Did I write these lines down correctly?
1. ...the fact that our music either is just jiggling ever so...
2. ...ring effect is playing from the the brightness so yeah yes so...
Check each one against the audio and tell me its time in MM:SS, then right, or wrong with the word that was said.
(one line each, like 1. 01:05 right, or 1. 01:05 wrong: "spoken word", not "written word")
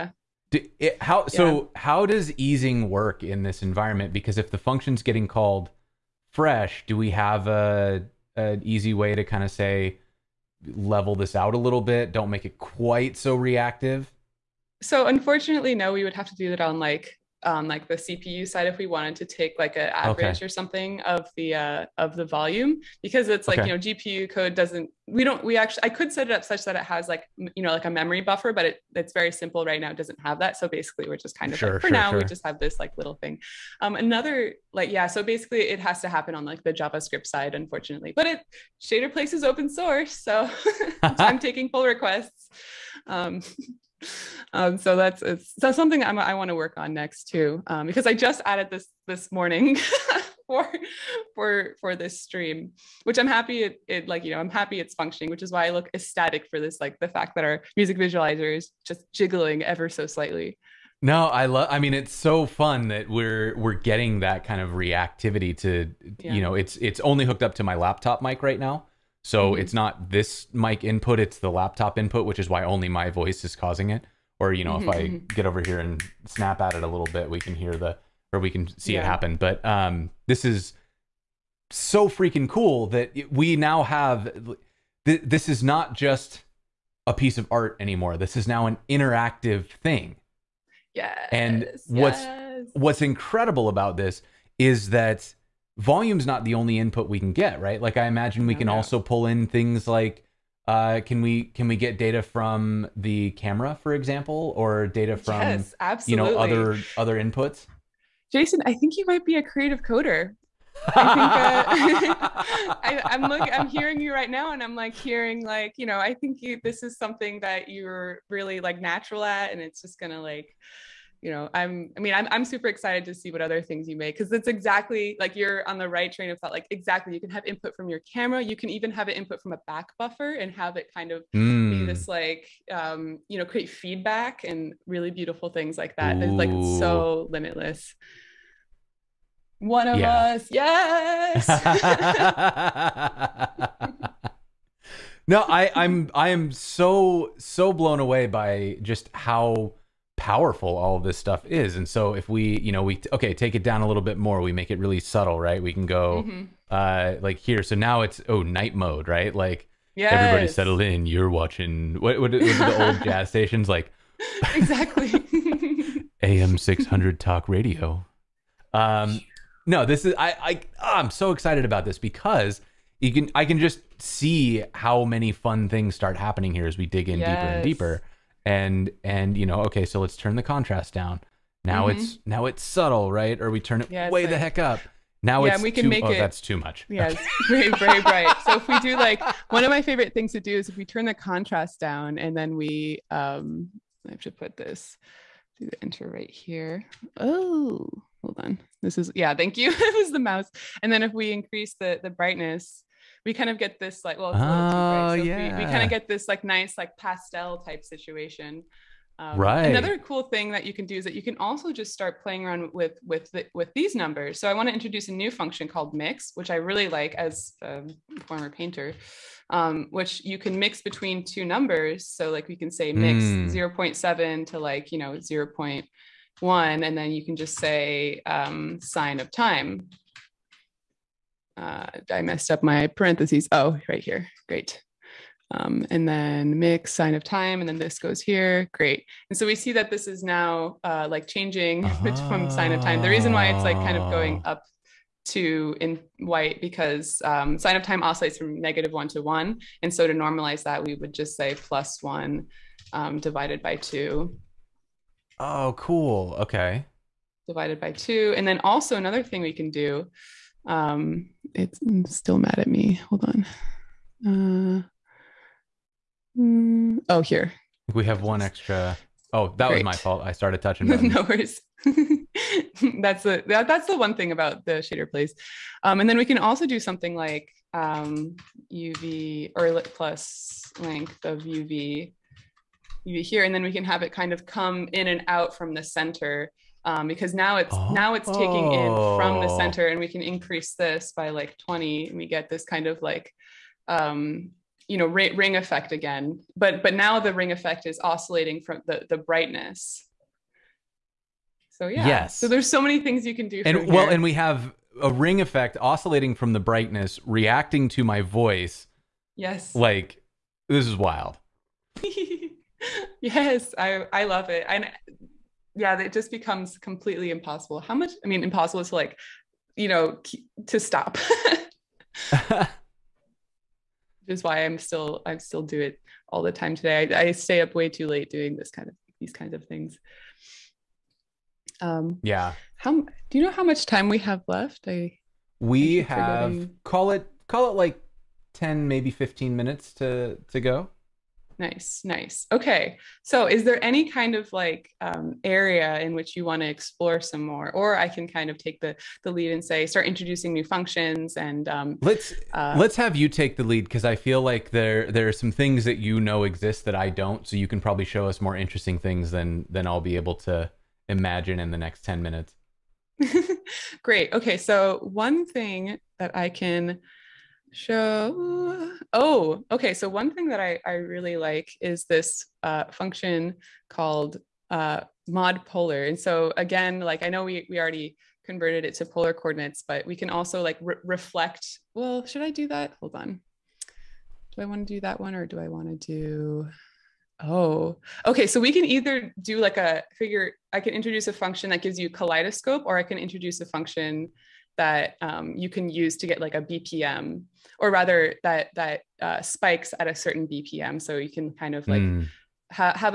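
1. 00:56 wrong: "visualizer", not "either"
2. 04:57 wrong: "oscillating", not "playing".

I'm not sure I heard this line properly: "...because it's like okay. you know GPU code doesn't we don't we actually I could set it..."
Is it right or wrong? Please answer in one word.
right.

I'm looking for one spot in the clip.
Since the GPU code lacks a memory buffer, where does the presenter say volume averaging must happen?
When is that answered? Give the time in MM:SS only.
00:36.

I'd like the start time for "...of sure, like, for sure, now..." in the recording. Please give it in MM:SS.
00:31.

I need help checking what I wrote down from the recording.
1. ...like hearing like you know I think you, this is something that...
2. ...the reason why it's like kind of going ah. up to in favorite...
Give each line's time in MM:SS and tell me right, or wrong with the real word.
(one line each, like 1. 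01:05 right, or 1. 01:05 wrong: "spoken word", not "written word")
1. 01:54 right
2. 04:03 wrong: "white", not "favorite".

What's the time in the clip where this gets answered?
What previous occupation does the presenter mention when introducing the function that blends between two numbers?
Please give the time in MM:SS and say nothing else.
03:38.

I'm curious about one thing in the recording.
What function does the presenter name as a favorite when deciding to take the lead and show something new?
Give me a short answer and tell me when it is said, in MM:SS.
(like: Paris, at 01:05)
mod polar, at 06:15.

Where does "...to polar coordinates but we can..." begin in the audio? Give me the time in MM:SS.
06:18.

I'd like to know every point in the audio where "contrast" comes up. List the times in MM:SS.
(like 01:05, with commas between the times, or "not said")
03:00, 03:11.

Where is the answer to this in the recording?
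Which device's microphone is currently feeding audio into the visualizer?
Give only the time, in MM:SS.
01:07.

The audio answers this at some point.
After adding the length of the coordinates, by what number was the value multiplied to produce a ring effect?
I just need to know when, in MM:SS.
04:51.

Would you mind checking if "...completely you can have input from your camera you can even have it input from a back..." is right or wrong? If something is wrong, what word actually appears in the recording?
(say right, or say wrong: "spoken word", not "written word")
wrong: "exactly", not "completely".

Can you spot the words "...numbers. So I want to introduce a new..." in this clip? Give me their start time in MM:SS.
03:33.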